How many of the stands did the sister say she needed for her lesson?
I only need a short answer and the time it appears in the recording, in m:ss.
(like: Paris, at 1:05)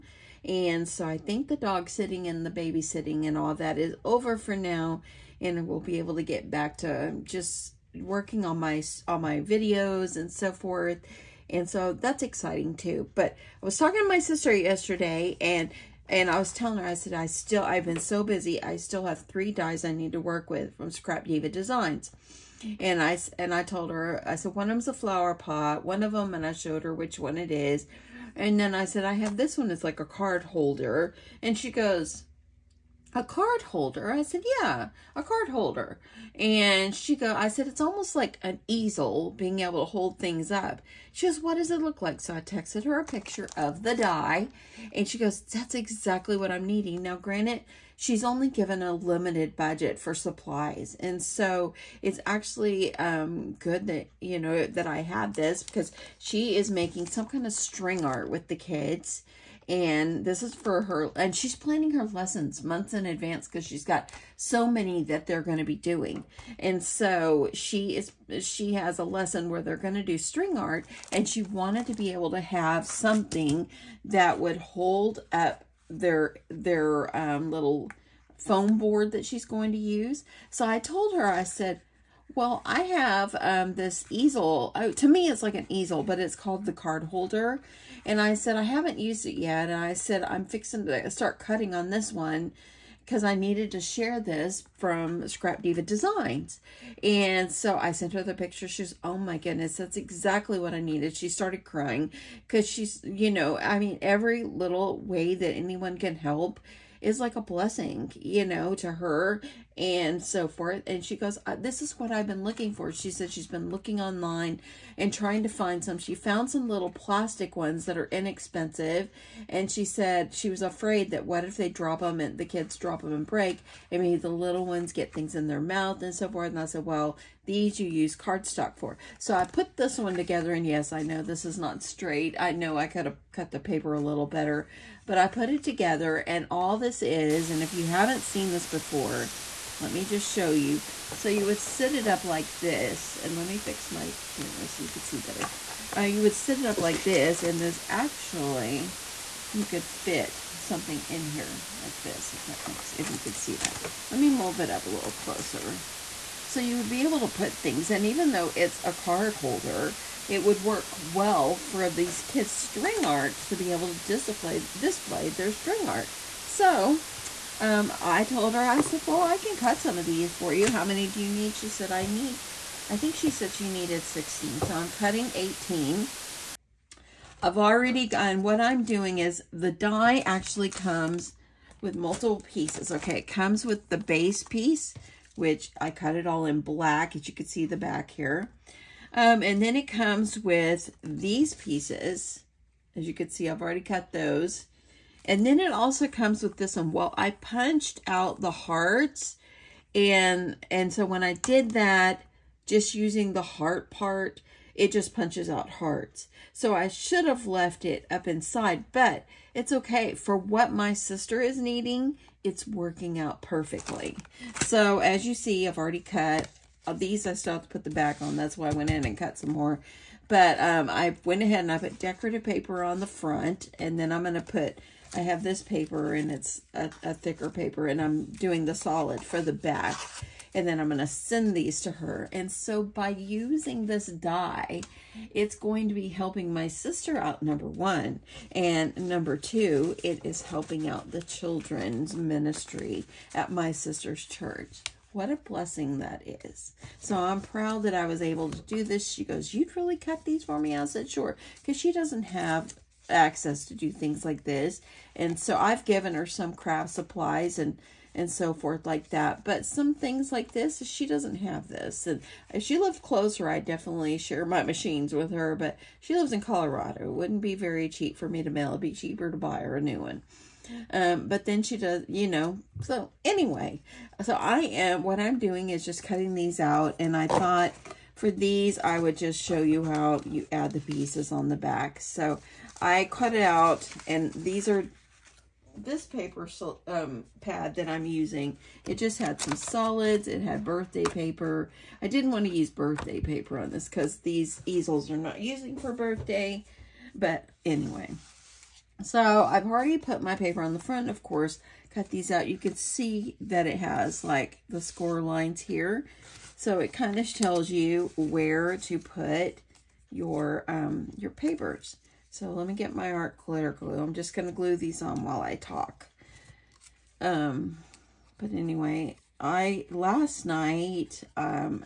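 16, at 2:54.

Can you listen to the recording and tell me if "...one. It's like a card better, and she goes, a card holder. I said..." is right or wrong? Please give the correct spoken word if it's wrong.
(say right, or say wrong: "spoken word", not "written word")
wrong: "holder", not "better".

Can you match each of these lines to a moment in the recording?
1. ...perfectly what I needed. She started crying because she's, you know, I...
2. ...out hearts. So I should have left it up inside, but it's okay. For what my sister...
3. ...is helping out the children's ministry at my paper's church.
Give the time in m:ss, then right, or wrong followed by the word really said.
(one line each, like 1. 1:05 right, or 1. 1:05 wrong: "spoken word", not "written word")
1. 1:39 wrong: "exactly", not "perfectly"
2. 3:25 right
3. 4:00 wrong: "sister", not "paper".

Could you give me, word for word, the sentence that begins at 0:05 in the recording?
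And we'll be able to get back to just working on my, on my videos and so forth.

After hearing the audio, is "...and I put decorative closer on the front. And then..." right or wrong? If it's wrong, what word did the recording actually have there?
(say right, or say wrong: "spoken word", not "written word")
wrong: "paper", not "closer".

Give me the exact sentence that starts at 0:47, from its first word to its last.
Now, granted, she's only given a limited budget for supplies.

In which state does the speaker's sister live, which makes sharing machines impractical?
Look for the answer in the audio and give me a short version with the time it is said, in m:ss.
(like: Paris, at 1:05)
Colorado, at 4:26.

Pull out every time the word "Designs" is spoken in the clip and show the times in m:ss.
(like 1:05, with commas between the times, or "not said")
0:21, 1:35.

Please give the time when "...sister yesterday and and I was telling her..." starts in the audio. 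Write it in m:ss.
0:14.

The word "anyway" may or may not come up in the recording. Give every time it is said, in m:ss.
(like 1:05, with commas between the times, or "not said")
4:33, 4:57, 5:18.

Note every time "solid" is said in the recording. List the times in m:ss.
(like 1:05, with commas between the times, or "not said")
3:48, 4:49.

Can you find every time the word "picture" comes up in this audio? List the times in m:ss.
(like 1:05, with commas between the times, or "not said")
0:43, 1:38.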